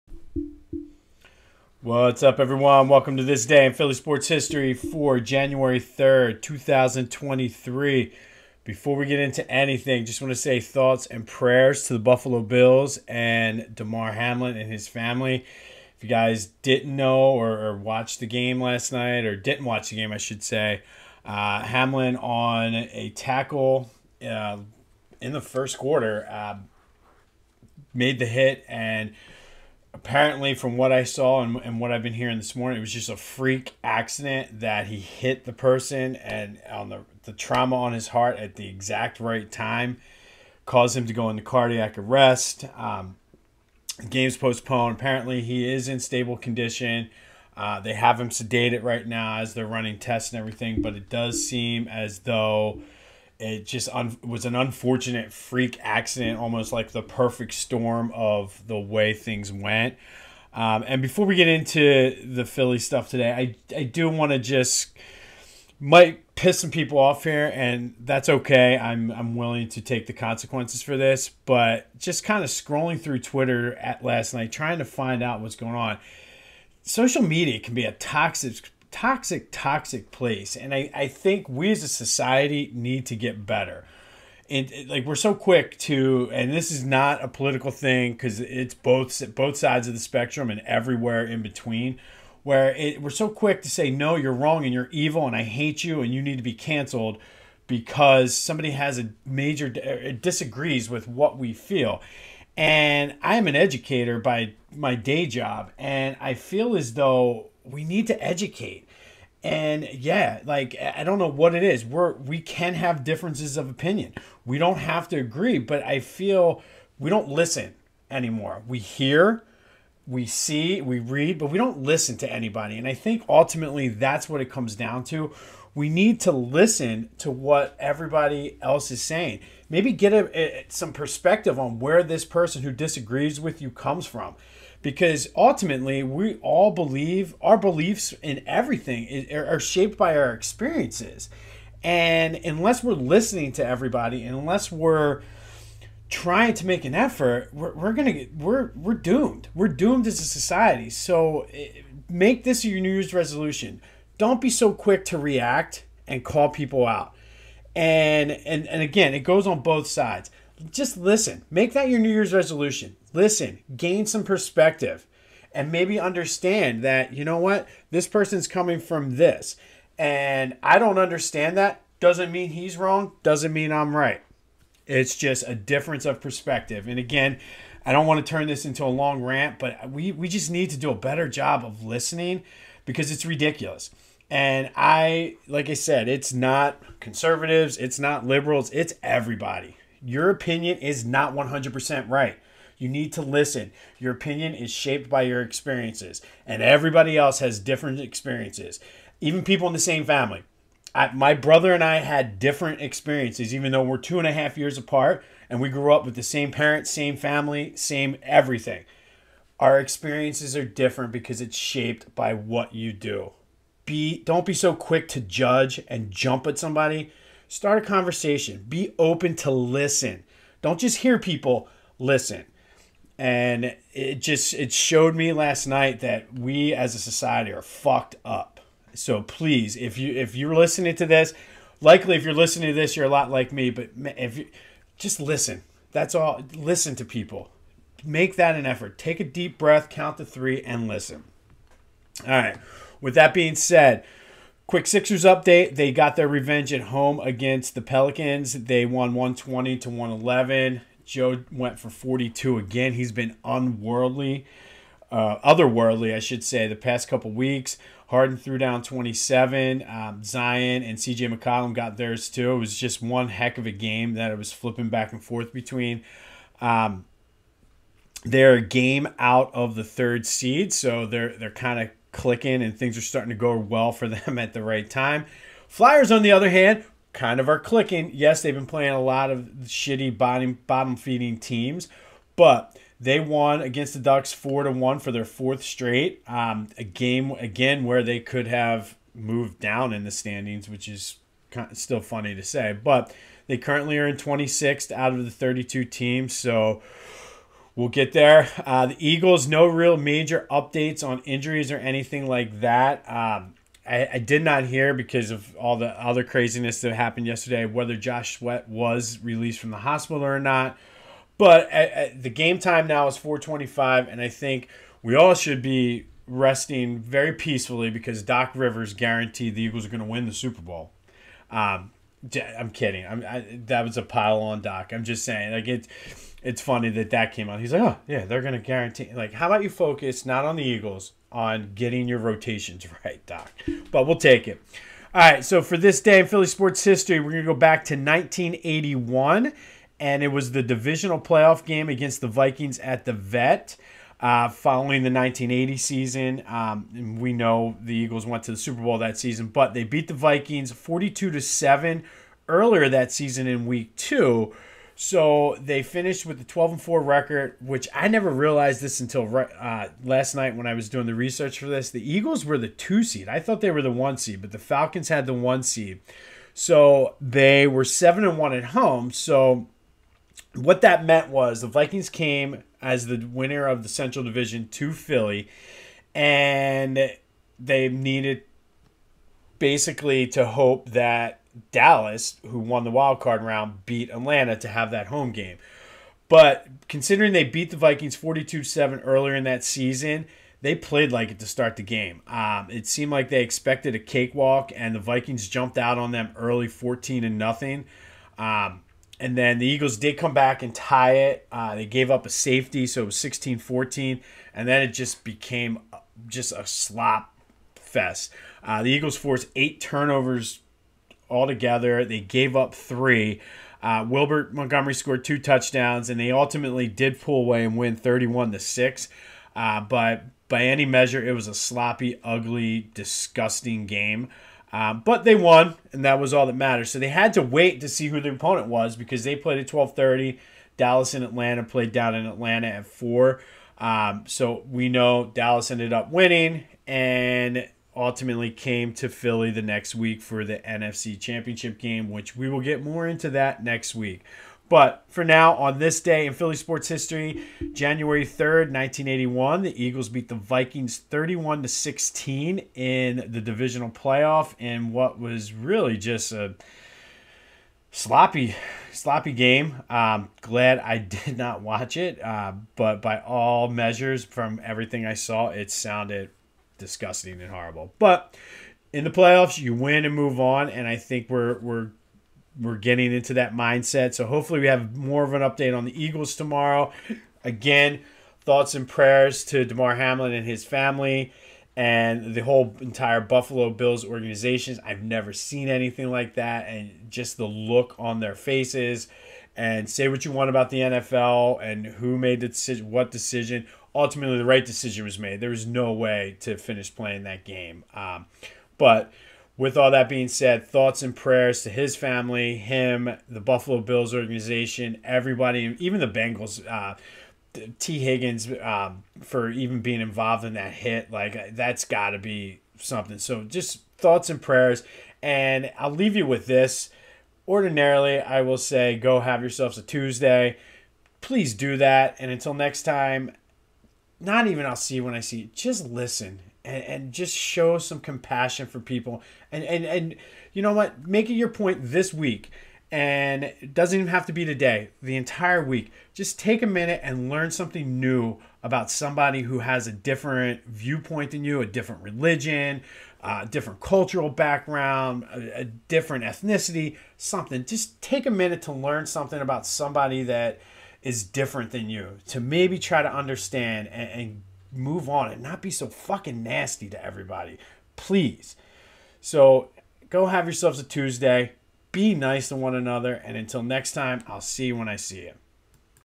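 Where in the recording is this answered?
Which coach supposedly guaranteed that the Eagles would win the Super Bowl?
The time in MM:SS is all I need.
05:18.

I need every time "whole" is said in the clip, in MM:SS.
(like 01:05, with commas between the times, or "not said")
08:02.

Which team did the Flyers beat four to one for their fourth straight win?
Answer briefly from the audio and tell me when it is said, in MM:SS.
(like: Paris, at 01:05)
Ducks, at 04:43.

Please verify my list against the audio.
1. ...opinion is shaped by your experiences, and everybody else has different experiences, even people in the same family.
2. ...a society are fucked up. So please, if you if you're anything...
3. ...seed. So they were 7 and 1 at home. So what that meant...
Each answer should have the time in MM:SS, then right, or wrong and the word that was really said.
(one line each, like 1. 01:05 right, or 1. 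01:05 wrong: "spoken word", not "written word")
1. 03:14 right
2. 03:46 wrong: "listening", not "anything"
3. 06:05 right.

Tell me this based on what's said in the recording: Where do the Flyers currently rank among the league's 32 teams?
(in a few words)
26th.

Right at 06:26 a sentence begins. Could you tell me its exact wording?
But considering they beat the Vikings 42 7 earlier in that season, they played like it to start the game.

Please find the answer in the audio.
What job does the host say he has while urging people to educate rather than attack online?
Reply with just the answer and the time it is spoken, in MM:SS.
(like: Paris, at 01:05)
educator, at 01:43.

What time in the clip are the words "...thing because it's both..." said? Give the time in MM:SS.
01:27.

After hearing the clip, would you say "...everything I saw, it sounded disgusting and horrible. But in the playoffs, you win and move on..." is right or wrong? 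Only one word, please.
right.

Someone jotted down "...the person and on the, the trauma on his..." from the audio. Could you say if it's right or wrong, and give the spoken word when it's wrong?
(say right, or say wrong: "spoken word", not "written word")
right.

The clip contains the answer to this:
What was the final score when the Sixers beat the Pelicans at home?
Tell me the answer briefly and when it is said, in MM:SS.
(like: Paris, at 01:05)
120 to 111, at 04:09.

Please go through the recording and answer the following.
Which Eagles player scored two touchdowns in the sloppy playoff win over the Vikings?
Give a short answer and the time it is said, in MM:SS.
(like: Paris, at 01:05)
Wilbert Montgomery, at 06:54.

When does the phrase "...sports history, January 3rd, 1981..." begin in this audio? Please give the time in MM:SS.
07:26.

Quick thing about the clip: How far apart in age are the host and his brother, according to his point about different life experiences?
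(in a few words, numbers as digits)
two and a half years.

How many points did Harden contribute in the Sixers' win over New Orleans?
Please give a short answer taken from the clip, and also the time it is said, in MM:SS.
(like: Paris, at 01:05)
27, at 04:18.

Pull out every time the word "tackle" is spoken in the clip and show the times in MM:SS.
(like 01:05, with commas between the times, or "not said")
00:23.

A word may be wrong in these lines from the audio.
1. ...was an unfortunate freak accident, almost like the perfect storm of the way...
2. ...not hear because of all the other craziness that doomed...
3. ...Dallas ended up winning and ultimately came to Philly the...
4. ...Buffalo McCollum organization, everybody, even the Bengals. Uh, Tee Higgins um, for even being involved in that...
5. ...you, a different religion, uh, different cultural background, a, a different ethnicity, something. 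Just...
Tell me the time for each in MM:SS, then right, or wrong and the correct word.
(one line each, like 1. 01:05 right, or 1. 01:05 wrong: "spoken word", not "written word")
1. 00:54 right
2. 05:04 wrong: "happened", not "doomed"
3. 07:15 right
4. 08:23 wrong: "Bills", not "McCollum"
5. 09:01 right.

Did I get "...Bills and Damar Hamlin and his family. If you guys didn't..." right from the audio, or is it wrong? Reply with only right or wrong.
right.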